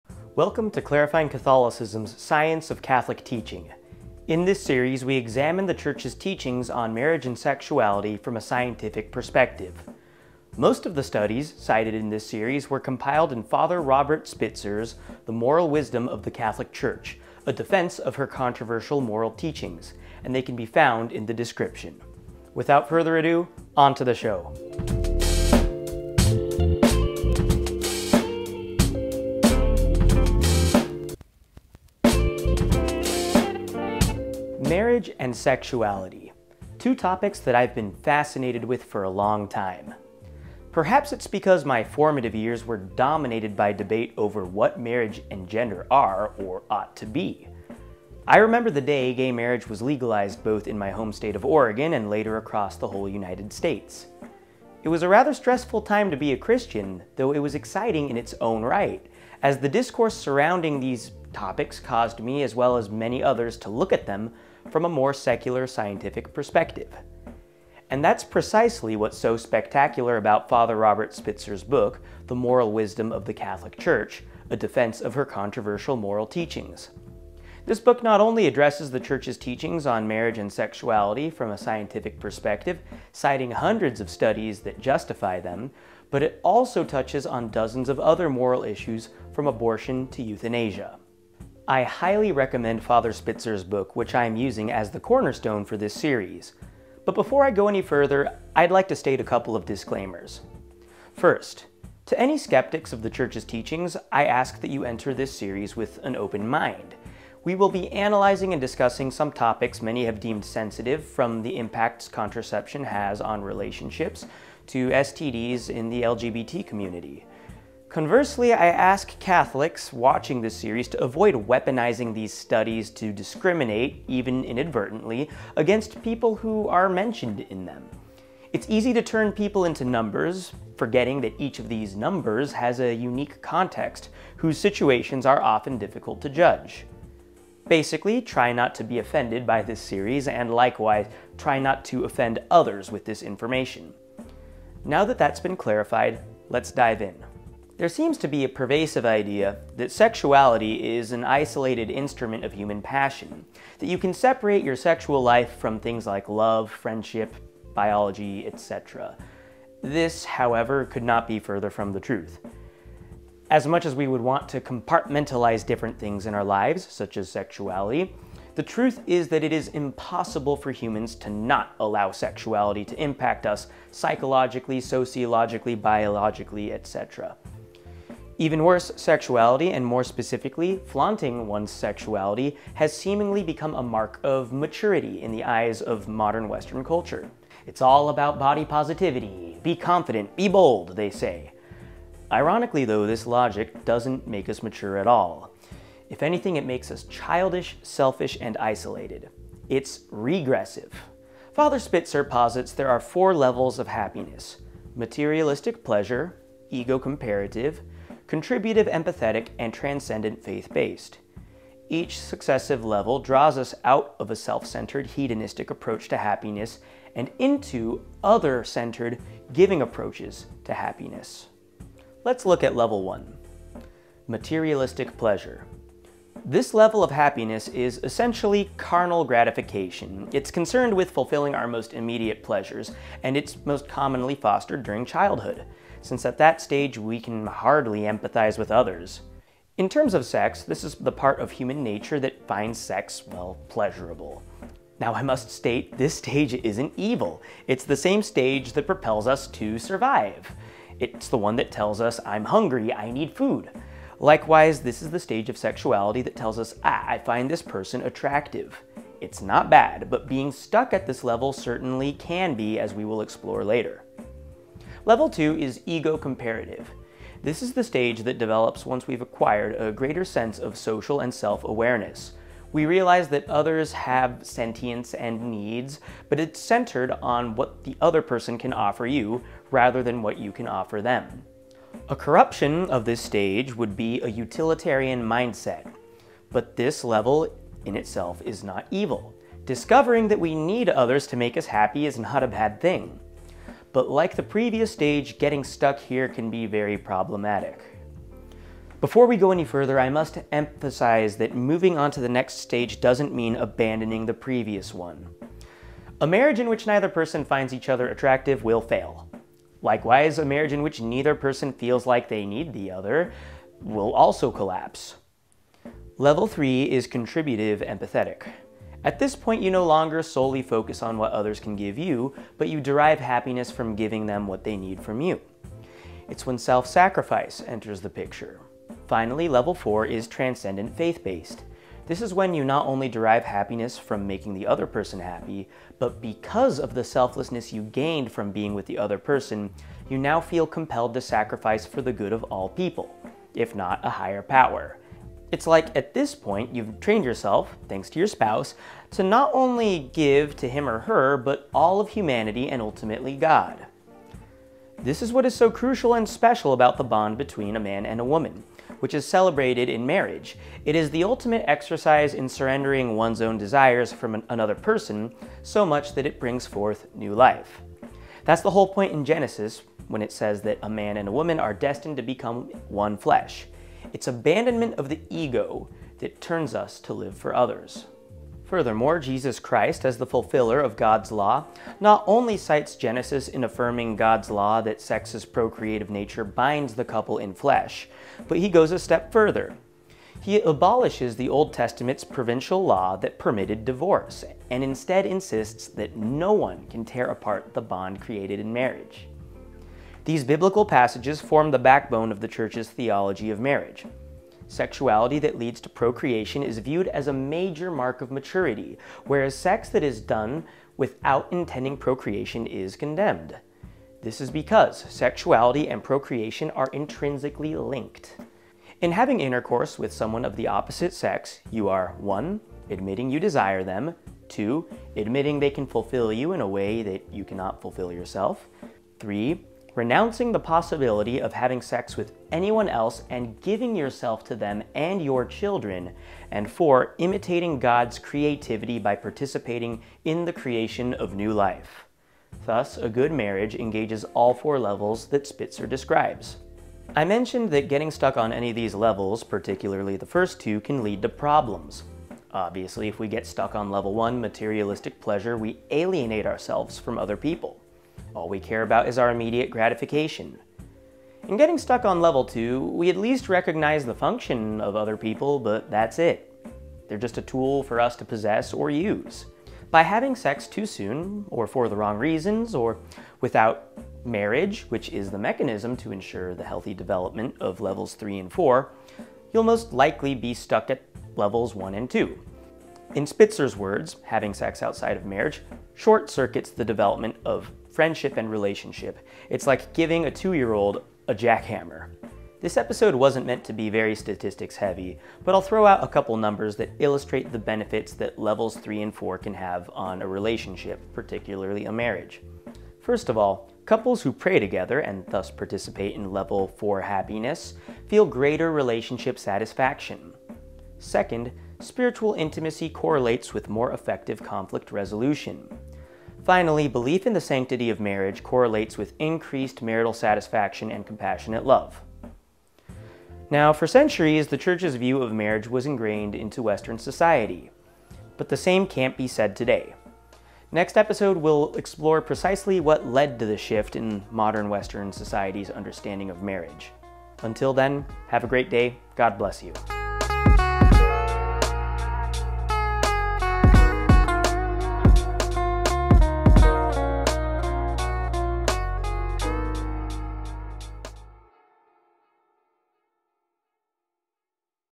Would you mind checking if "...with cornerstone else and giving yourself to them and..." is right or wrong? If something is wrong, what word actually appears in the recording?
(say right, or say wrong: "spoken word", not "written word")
wrong: "anyone", not "cornerstone".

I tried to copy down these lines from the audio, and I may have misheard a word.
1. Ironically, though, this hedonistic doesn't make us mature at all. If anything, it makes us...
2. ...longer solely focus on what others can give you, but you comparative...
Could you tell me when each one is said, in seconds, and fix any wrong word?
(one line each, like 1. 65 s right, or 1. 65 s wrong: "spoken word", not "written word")
1. 192 s wrong: "logic", not "hedonistic"
2. 319 s wrong: "derive", not "comparative".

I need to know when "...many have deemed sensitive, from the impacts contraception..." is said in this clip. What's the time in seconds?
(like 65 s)
109 s.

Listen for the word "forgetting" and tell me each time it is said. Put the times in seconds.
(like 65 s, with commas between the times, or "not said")
130 s.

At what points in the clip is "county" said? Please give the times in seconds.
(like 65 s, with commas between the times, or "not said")
not said.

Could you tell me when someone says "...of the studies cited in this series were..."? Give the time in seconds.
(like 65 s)
10 s.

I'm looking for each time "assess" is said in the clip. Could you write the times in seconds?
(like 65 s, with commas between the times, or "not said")
not said.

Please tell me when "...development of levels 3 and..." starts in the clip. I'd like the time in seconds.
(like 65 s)
476 s.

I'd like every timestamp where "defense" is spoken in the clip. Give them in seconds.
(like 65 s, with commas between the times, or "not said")
17 s, 74 s.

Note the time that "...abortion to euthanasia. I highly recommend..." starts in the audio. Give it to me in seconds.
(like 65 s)
89 s.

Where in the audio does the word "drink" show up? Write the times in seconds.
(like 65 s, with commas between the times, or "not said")
not said.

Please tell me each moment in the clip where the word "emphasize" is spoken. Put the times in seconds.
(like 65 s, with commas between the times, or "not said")
300 s.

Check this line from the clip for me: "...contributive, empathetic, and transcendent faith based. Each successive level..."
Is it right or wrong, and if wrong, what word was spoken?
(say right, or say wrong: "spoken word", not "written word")
right.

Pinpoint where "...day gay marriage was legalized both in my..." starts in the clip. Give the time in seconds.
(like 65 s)
48 s.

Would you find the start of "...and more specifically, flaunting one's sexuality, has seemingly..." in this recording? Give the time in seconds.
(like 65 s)
179 s.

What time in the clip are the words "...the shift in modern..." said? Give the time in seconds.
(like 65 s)
533 s.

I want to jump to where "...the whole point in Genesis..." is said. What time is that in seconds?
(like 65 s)
368 s.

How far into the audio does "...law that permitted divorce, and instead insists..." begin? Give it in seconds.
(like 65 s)
392 s.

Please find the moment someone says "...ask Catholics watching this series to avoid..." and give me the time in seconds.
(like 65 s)
118 s.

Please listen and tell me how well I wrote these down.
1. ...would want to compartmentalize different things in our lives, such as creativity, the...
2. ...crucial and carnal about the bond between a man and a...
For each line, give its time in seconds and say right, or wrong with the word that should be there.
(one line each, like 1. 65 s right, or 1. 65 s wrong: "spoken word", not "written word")
1. 164 s wrong: "sexuality", not "creativity"
2. 355 s wrong: "special", not "carnal".